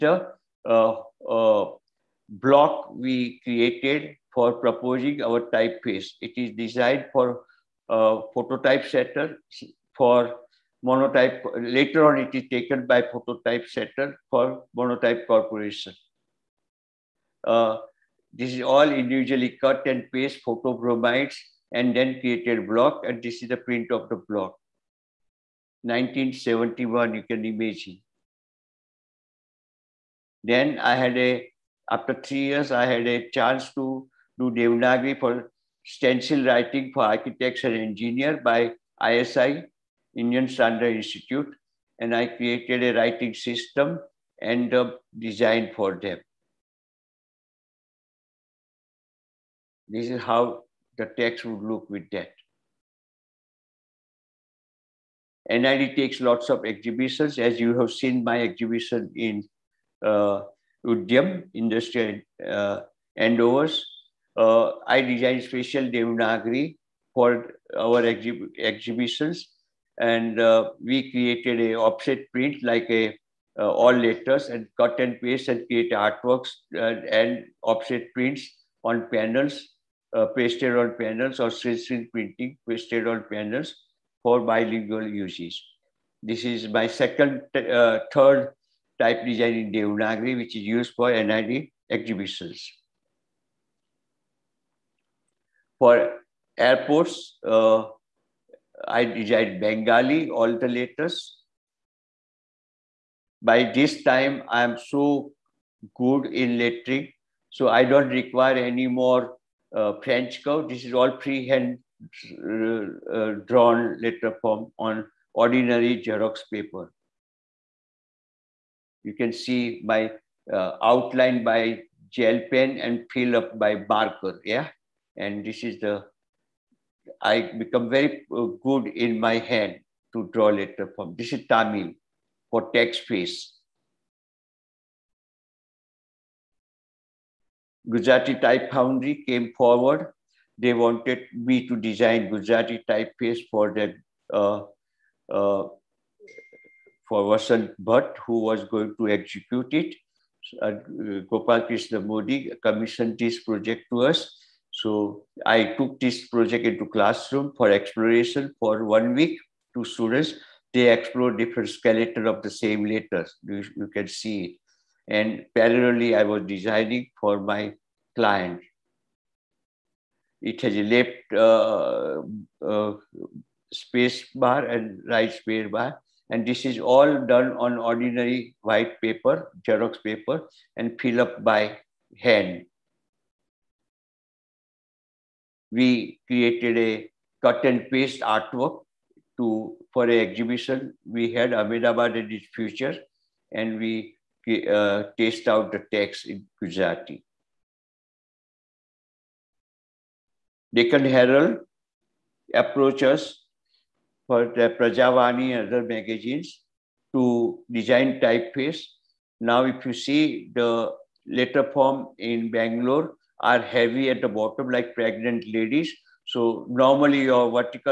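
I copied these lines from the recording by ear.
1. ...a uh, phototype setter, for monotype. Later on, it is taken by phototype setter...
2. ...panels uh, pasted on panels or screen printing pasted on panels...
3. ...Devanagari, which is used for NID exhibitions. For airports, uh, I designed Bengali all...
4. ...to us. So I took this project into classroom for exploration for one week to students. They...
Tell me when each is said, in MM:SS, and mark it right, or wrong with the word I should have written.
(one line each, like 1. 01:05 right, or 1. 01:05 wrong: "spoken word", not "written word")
1. 00:07 right
2. 01:19 right
3. 01:29 right
4. 02:33 right.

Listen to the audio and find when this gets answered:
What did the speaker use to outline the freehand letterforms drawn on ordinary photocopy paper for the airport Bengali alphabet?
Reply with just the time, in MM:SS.
02:02.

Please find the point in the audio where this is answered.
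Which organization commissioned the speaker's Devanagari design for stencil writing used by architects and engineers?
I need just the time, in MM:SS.
00:40.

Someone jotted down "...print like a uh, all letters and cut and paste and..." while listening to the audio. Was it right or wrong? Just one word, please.
right.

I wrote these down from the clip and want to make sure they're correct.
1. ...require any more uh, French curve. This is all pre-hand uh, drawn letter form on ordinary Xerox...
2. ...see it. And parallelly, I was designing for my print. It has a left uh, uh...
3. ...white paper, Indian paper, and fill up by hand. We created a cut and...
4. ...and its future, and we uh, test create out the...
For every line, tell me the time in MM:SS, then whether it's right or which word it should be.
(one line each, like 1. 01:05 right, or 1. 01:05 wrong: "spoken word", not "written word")
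1. 01:48 right
2. 02:44 wrong: "client", not "print"
3. 02:58 wrong: "Xerox", not "Indian"
4. 03:12 wrong: "taste", not "create".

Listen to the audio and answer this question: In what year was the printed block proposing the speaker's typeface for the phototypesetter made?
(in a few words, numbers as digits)
1971.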